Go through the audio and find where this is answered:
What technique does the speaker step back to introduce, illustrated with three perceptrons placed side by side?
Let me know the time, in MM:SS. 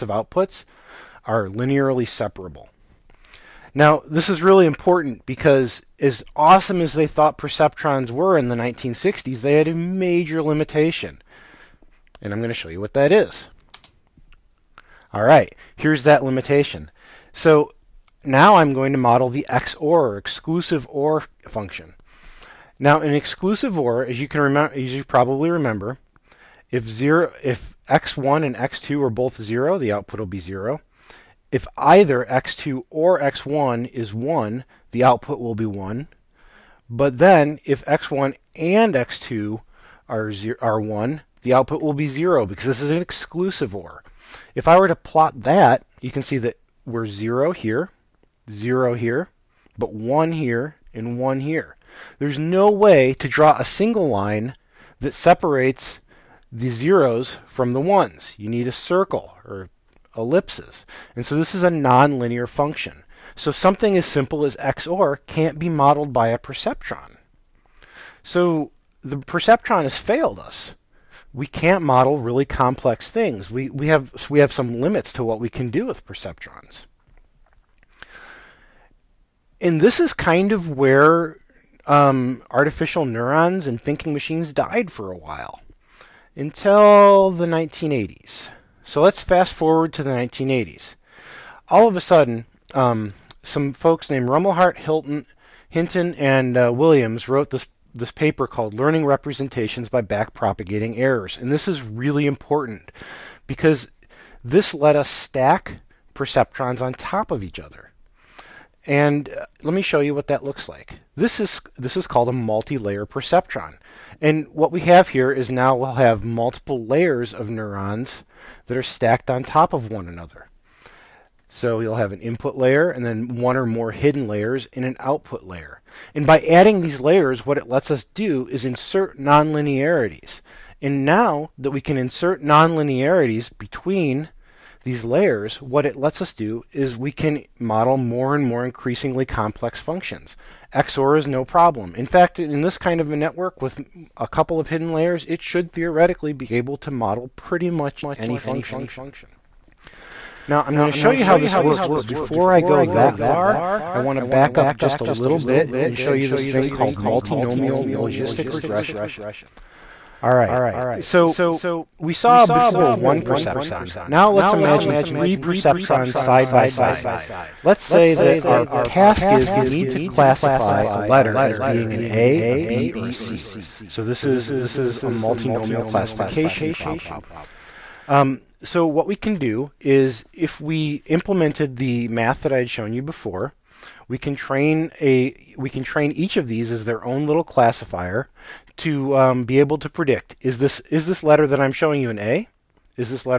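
02:36.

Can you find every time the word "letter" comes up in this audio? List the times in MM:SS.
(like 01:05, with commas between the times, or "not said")
02:51, 03:11.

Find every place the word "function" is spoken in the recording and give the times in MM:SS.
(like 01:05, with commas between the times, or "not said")
00:21, 01:02, 02:19, 02:28.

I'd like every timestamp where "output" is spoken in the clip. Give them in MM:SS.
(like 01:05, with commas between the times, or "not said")
00:00, 00:29, 00:35, 00:41, 02:04.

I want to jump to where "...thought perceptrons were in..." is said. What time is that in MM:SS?
00:07.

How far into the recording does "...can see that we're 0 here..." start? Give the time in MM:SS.
00:46.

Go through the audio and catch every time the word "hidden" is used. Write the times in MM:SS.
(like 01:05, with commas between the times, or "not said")
02:03, 02:24.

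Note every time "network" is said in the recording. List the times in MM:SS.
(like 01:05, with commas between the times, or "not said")
02:23.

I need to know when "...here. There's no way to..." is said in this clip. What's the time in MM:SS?
00:51.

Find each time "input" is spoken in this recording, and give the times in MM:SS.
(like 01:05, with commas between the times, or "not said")
02:02.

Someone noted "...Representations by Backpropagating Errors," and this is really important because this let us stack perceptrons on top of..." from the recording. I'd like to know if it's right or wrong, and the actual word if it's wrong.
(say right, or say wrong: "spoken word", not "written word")
right.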